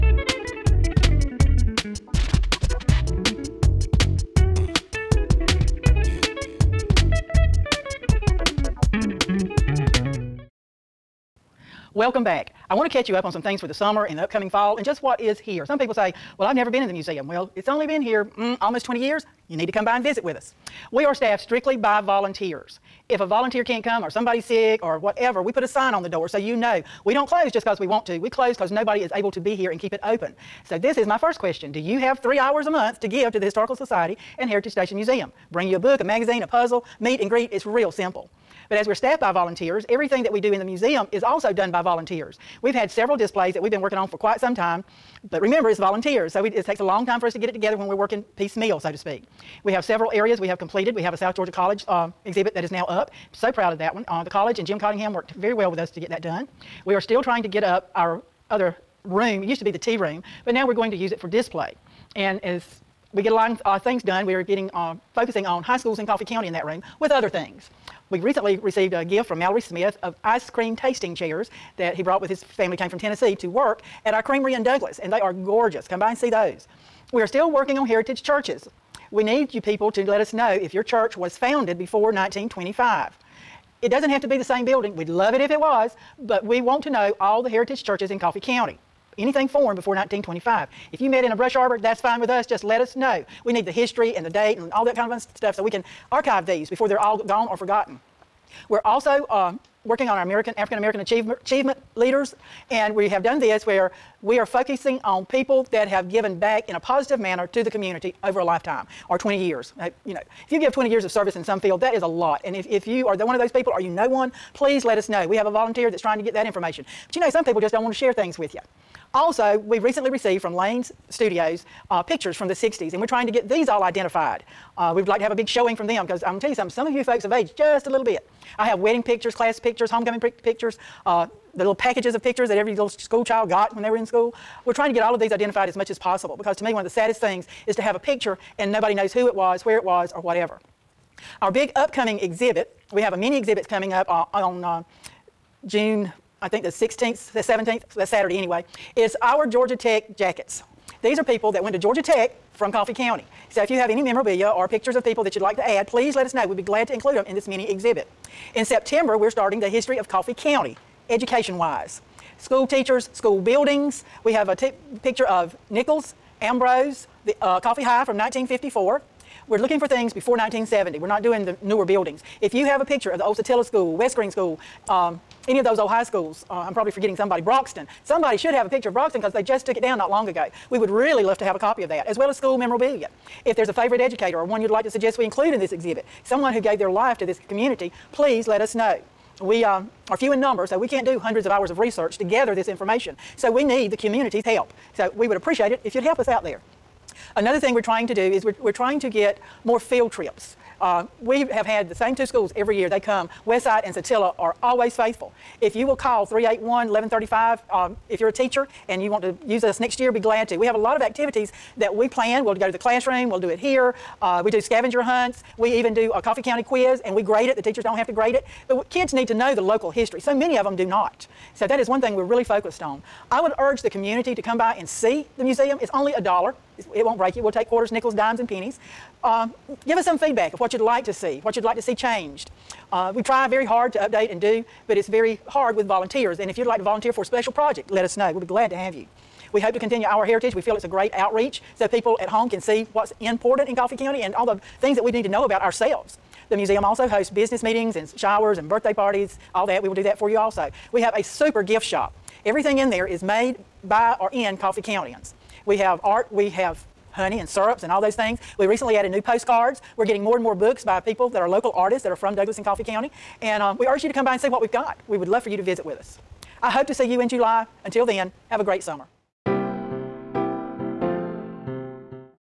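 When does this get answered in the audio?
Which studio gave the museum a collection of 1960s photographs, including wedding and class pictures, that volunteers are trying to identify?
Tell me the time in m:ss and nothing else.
2:00.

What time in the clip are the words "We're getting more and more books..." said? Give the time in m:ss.
4:19.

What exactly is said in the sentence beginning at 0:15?
Some people say, well, I've never been in the museum.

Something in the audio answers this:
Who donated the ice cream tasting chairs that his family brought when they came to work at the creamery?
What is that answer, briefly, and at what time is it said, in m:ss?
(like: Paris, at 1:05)
Mallory Smith, at 1:09.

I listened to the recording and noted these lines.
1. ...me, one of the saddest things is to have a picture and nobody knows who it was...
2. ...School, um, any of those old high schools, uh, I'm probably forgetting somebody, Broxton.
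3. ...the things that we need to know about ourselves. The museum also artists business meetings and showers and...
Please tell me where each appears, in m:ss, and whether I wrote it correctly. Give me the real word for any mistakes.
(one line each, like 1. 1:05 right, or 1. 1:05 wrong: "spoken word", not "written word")
1. 2:16 right
2. 2:54 right
3. 4:04 wrong: "hosts", not "artists".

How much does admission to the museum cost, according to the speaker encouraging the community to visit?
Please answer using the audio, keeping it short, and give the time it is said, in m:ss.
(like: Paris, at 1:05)
$1, at 3:46.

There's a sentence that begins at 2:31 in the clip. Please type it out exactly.
These are people that went to Georgia Tech from Coffee County.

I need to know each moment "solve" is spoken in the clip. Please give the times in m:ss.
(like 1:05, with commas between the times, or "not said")
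not said.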